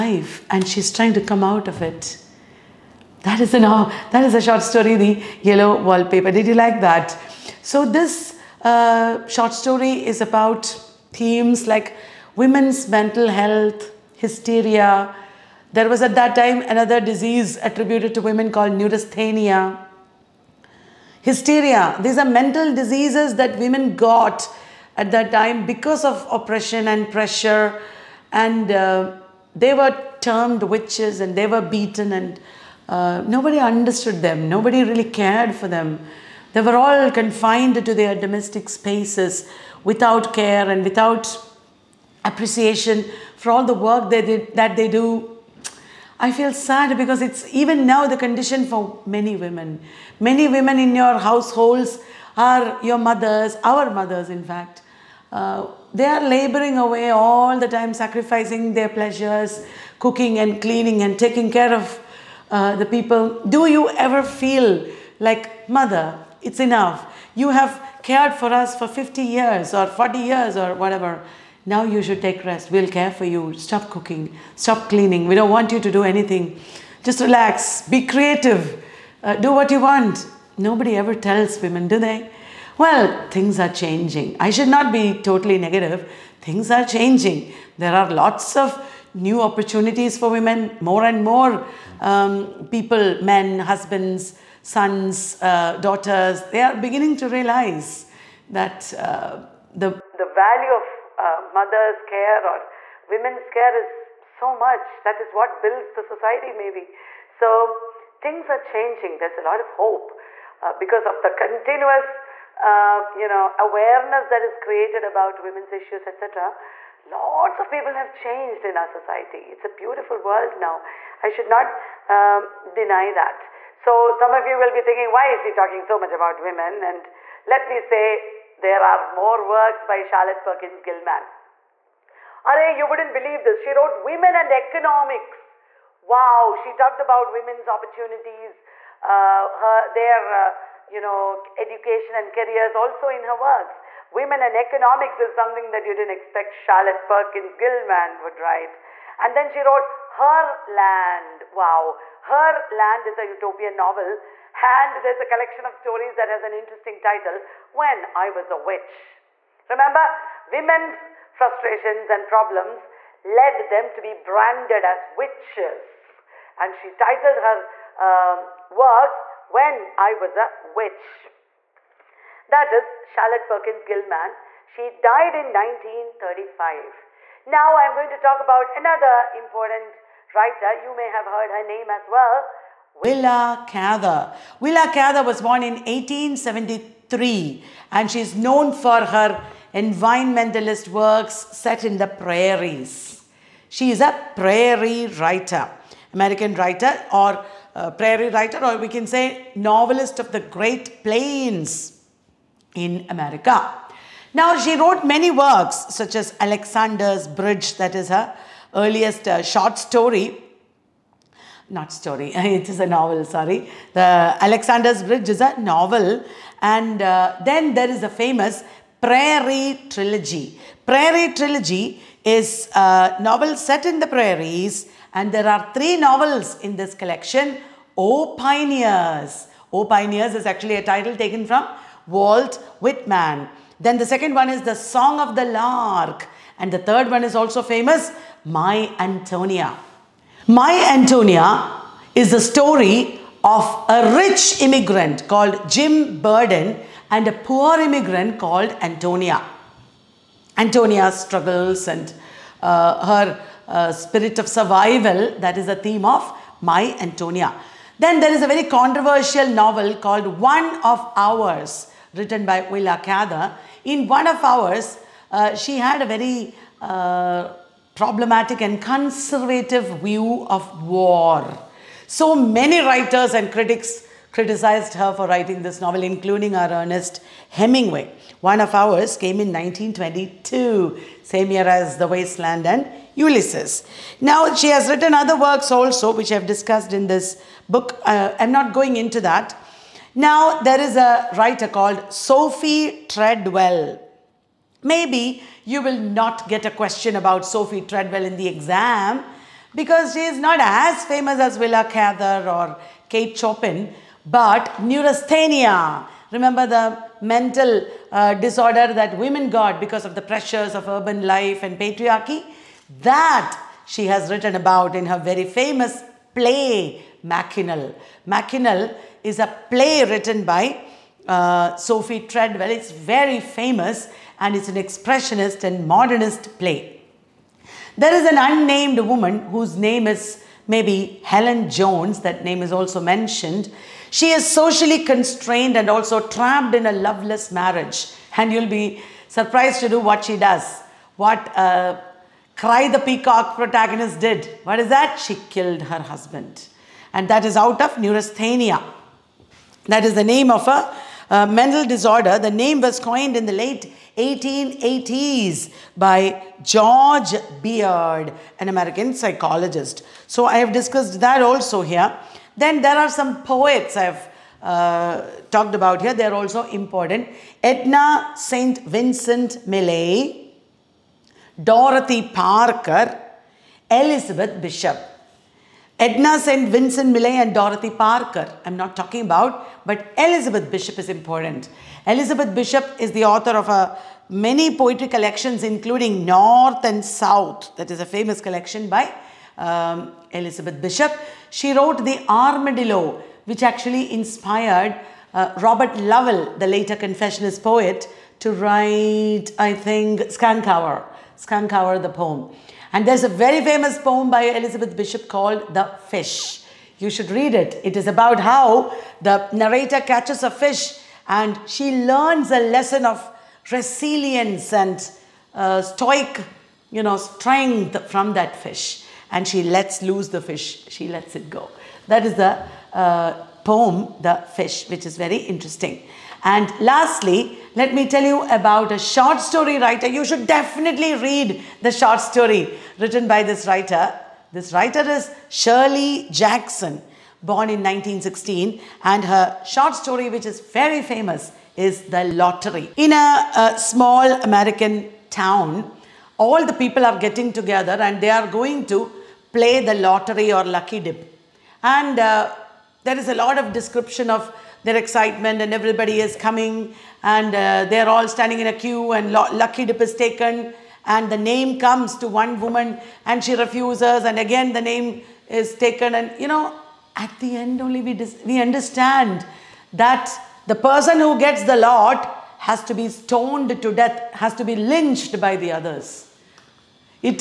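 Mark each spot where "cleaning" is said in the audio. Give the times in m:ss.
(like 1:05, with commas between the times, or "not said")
1:00, 1:14.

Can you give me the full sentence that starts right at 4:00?
My Antonia is the story of a rich immigrant called Jim Burden and a poor immigrant called Antonia.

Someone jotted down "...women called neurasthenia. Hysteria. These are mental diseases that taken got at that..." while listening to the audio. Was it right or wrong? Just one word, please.
wrong.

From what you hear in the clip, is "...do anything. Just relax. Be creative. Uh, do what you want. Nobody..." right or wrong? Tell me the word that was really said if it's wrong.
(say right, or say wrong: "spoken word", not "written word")
right.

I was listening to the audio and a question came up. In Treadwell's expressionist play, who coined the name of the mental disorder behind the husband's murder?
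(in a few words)
George Beard.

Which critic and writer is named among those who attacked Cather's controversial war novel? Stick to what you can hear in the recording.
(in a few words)
Ernest Hemingway.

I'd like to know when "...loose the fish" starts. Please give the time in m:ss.
7:00.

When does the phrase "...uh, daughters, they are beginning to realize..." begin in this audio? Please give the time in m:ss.
1:35.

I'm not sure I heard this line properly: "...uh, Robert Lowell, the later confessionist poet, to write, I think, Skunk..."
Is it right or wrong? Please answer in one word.
right.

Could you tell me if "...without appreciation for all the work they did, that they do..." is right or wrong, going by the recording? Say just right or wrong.
right.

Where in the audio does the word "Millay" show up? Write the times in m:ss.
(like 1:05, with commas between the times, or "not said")
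6:09, 6:17.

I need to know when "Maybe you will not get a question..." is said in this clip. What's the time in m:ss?
4:54.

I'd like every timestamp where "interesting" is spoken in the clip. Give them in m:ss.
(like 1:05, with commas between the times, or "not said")
2:36, 7:05.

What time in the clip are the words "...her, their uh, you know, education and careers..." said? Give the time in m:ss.
2:19.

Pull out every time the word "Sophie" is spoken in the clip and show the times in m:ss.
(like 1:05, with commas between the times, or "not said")
4:52, 4:57, 5:21.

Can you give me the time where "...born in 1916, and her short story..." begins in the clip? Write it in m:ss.
7:17.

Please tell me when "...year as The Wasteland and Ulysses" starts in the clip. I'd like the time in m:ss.
4:41.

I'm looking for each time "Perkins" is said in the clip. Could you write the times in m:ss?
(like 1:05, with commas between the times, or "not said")
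2:10, 2:27, 2:53.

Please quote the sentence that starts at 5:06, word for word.
Remember the mental uh, disorder that women got because of the pressures of urban life and patriarchy?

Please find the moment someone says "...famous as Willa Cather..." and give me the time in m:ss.
5:01.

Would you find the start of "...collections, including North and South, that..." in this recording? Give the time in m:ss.
6:25.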